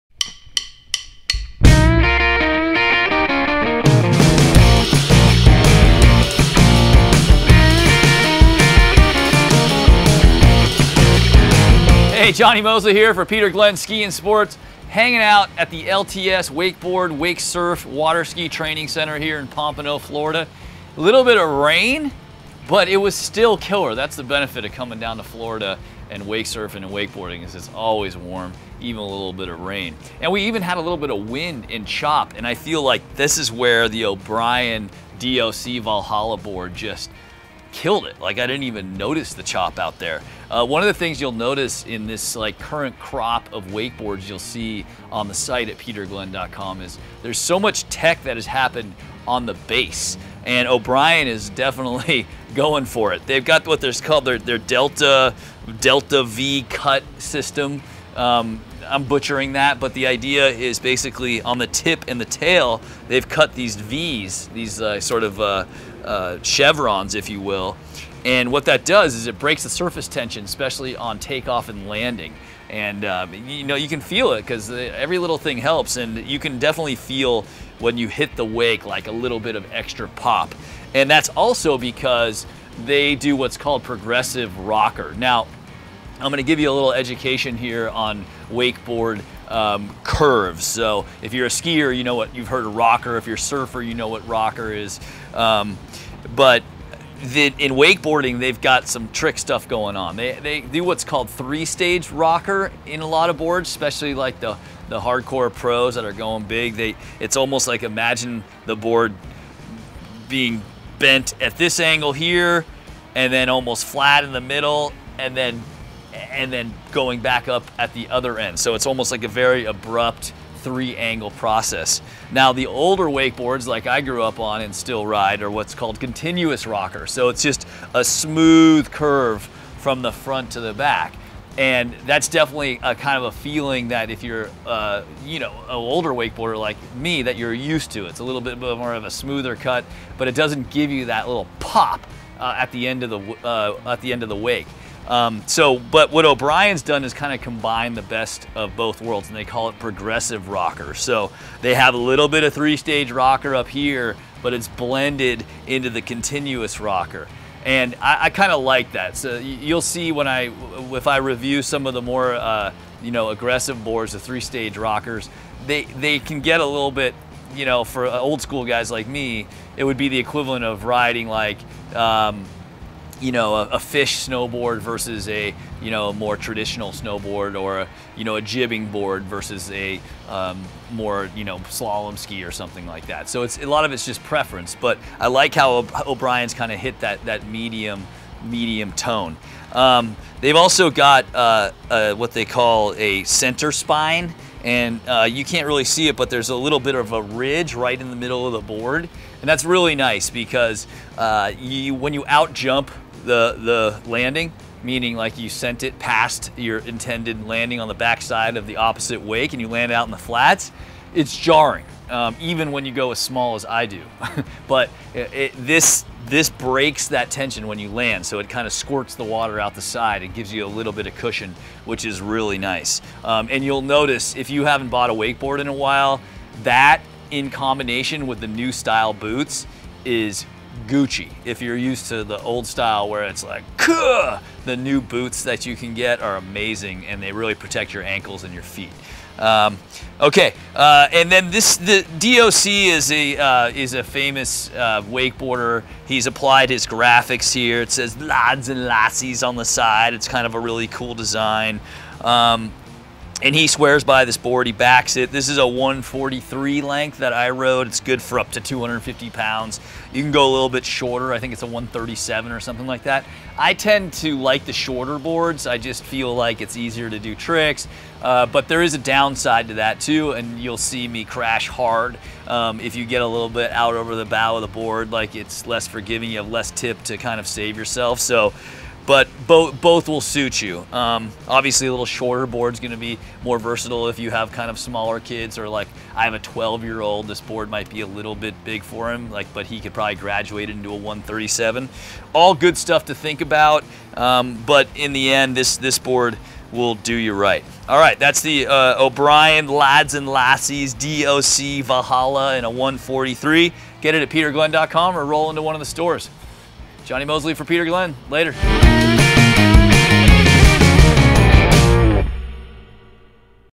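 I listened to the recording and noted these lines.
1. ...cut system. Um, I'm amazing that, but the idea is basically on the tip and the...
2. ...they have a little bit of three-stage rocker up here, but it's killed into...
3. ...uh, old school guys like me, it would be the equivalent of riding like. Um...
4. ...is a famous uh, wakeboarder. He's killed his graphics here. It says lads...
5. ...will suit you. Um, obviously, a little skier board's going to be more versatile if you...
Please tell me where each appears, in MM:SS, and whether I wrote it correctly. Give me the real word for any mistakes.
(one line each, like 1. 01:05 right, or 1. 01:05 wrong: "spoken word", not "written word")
1. 00:56 wrong: "butchering", not "amazing"
2. 02:31 wrong: "blended", not "killed"
3. 02:48 right
4. 04:03 wrong: "applied", not "killed"
5. 04:40 wrong: "shorter", not "skier".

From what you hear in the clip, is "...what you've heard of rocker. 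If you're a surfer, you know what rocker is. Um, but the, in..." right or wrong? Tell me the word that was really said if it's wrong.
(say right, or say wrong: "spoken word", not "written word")
right.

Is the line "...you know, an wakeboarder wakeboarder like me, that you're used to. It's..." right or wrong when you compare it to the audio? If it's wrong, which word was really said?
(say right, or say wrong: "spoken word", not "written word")
wrong: "older", not "wakeboarder".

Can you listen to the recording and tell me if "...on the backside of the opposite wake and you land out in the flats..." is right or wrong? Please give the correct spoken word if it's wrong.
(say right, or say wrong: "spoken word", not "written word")
right.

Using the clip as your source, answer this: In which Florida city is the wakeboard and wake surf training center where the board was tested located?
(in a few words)
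Pompano.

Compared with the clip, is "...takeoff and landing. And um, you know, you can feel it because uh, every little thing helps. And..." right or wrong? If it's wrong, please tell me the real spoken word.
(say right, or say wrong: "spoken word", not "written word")
right.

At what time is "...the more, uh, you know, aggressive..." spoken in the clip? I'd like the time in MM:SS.
02:41.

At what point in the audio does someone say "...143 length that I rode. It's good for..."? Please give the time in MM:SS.
04:15.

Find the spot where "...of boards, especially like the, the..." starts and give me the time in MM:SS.
01:43.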